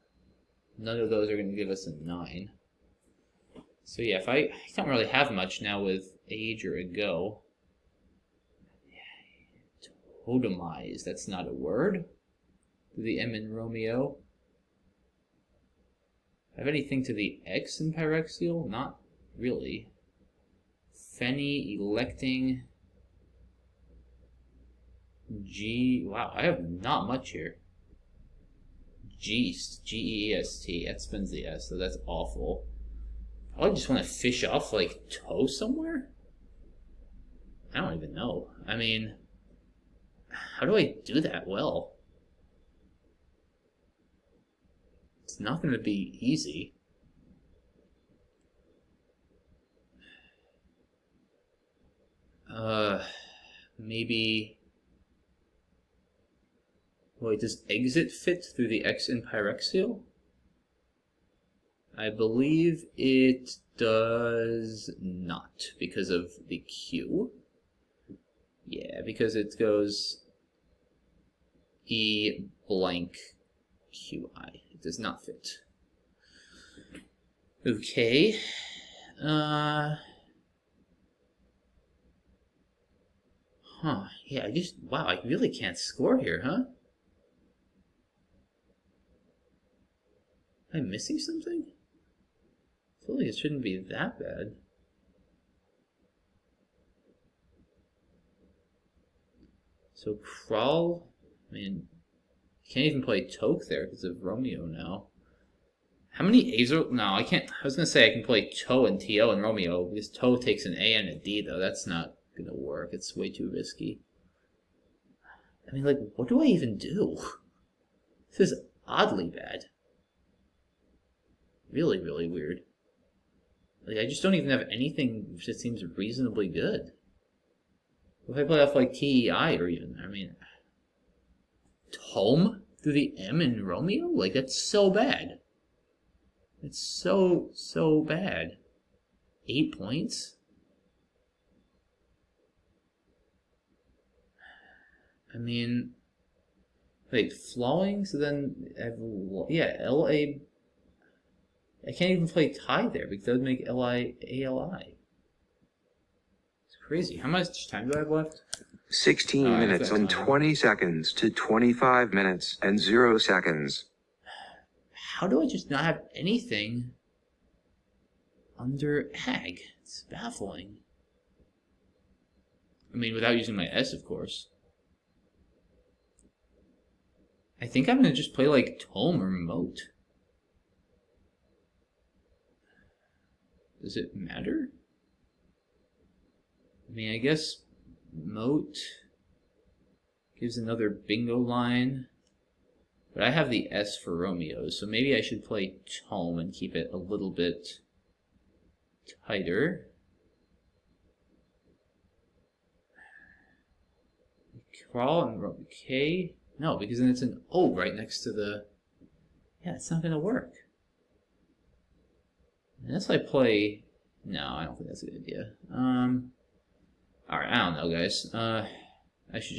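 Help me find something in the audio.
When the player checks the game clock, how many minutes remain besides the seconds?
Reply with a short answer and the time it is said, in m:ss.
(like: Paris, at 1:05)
16, at 2:38.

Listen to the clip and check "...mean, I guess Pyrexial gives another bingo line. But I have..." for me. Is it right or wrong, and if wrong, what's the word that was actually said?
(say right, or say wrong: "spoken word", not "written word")
wrong: "Moat", not "Pyrexial".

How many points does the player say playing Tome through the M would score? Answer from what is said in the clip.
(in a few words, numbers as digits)
8.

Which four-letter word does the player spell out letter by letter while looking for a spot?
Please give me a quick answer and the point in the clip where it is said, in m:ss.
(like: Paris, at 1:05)
Geest, at 0:29.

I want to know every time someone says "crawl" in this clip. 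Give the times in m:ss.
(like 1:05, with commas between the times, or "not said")
1:40, 3:24.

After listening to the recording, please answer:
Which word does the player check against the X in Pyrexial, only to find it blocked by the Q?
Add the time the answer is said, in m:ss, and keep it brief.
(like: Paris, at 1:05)
exit, at 0:57.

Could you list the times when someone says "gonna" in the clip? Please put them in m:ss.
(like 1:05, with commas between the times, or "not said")
1:52, 2:57.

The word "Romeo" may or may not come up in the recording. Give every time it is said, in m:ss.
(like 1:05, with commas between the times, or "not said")
0:13, 1:44, 1:49, 2:13, 3:14.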